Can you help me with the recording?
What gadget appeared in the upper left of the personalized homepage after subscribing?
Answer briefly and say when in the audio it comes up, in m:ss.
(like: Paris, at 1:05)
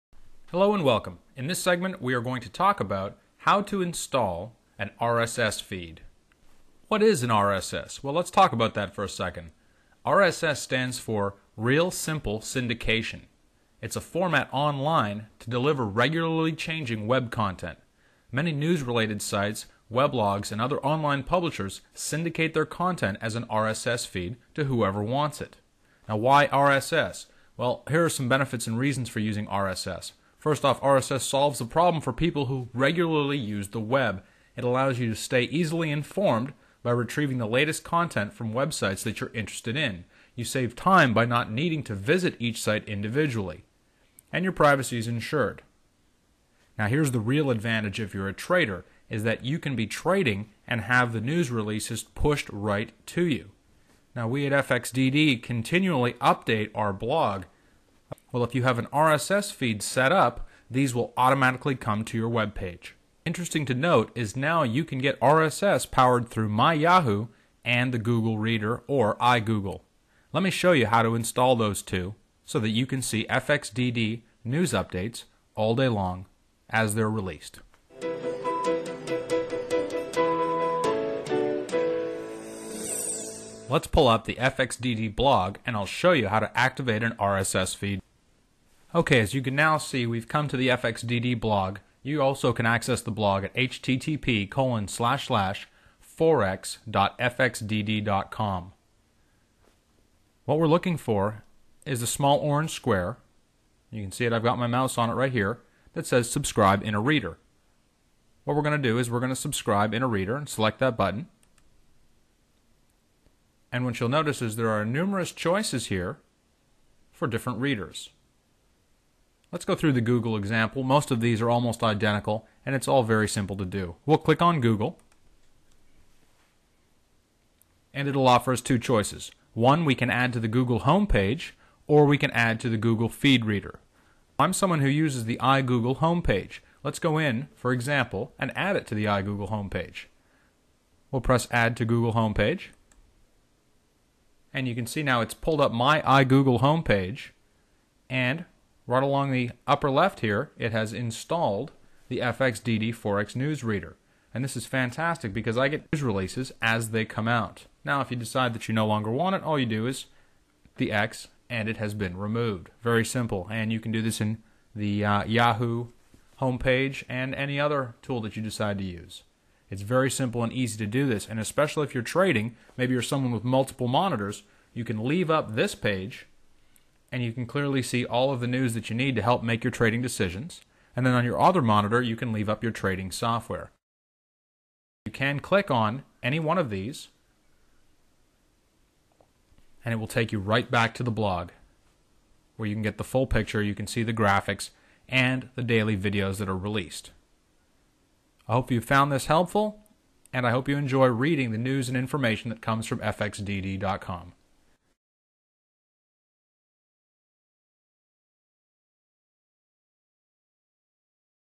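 FXDD Forex News Reader, at 2:32.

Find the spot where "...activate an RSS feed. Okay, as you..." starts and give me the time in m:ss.
1:26.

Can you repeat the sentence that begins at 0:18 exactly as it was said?
Many news related sites, weblogs, and other online publishers syndicate their content as an RSS feed to whoever wants it.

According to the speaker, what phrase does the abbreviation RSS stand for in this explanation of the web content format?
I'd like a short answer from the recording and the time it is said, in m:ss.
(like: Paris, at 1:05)
Real Simple Syndication, at 0:11.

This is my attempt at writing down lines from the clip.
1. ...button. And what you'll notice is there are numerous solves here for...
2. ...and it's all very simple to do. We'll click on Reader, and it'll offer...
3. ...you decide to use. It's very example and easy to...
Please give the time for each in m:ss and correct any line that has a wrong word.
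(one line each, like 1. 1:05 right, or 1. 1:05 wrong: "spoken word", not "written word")
1. 1:50 wrong: "choices", not "solves"
2. 2:02 wrong: "Google", not "Reader"
3. 2:48 wrong: "simple", not "example".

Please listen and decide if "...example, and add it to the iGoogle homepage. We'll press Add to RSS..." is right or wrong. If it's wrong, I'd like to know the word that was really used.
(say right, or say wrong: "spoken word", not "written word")
wrong: "Google", not "RSS".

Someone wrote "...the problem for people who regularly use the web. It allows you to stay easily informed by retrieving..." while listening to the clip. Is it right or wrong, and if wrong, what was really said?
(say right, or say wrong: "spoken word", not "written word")
right.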